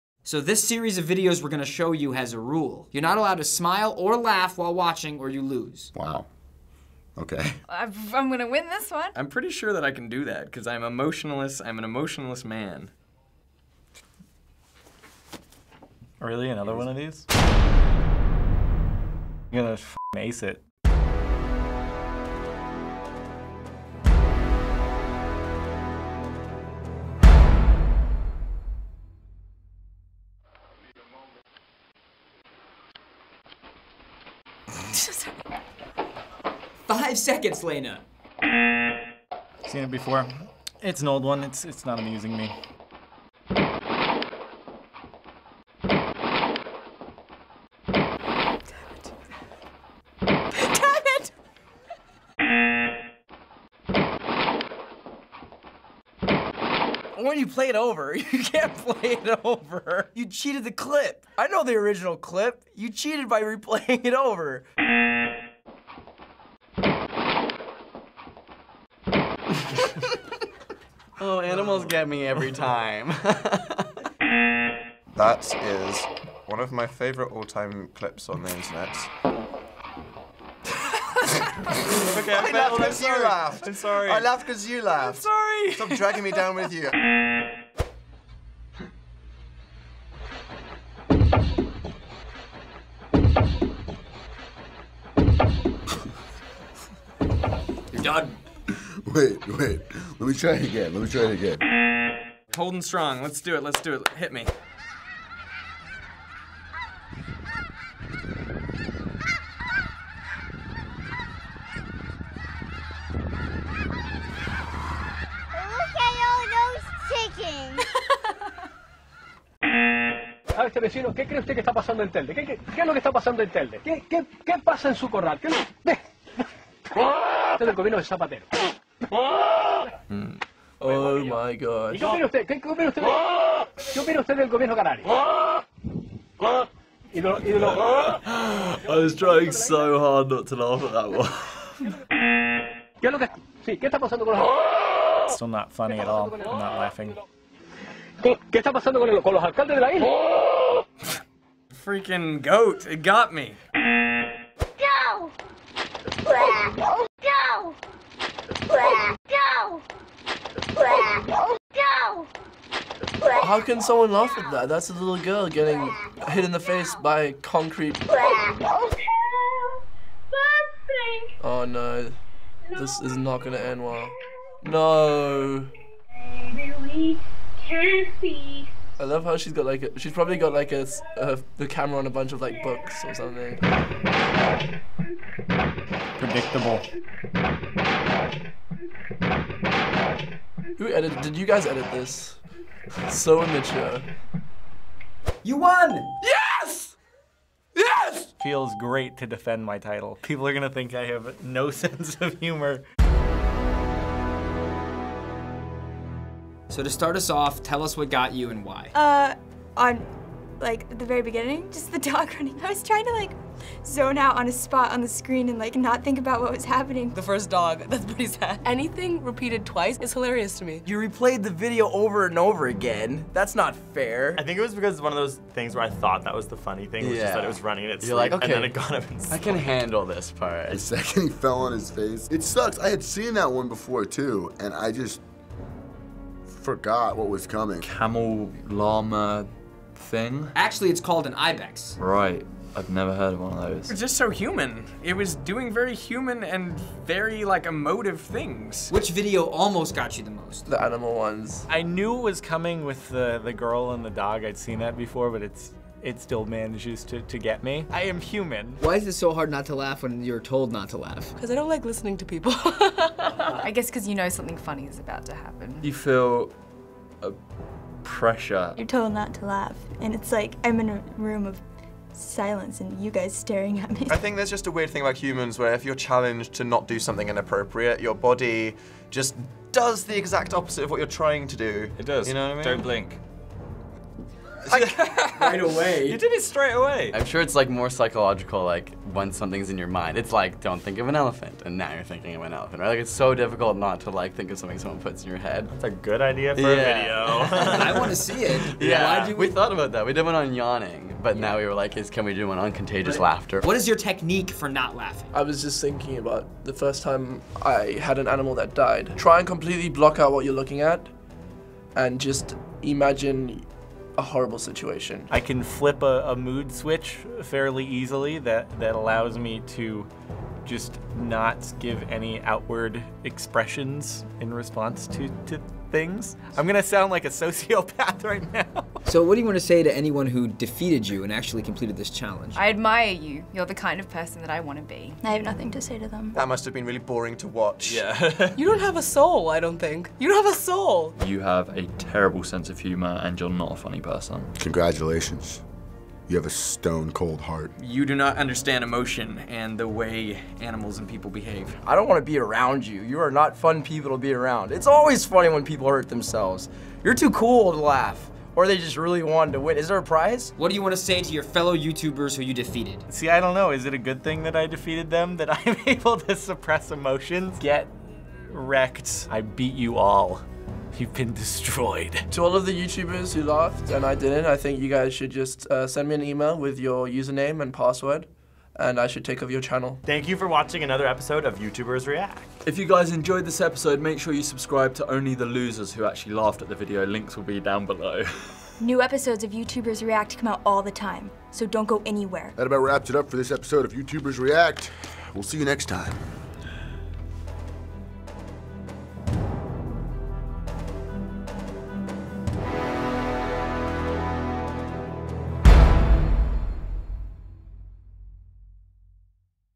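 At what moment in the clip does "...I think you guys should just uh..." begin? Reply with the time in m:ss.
6:14.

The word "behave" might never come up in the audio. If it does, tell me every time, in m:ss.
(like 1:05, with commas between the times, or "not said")
5:51.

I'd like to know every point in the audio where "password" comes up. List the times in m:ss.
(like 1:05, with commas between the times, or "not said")
6:17.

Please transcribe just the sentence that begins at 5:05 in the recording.
I was just thinking about the first time I had an animal that died.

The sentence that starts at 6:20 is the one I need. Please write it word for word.
Thank you for watching another episode of YouTubers React.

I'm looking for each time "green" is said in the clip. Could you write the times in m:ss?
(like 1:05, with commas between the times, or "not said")
not said.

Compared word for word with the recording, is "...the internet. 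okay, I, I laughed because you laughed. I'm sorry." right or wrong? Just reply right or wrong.
right.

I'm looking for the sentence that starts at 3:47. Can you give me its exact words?
is that it was running and it's You're like, okay, and then it got up and I can handle this part.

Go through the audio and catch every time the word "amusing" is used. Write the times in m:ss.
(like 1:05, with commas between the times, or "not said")
0:41.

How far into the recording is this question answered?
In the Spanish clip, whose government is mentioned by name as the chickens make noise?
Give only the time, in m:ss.
2:08.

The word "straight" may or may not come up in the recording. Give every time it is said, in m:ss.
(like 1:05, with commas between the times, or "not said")
4:46.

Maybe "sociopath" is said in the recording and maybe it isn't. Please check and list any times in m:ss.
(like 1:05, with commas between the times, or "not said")
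5:27.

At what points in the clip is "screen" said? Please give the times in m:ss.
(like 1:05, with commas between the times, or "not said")
3:35.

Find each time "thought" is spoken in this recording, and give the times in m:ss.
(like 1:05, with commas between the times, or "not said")
3:45, 4:59.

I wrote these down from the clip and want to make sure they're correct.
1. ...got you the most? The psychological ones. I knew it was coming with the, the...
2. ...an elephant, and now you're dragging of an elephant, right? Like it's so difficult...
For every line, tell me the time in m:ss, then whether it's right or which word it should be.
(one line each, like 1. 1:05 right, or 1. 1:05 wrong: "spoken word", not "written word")
1. 4:09 wrong: "animal", not "psychological"
2. 4:51 wrong: "thinking", not "dragging".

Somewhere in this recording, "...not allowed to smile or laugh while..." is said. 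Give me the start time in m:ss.
0:03.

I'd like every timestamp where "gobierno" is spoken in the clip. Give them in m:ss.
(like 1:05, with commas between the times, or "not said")
2:07, 2:14.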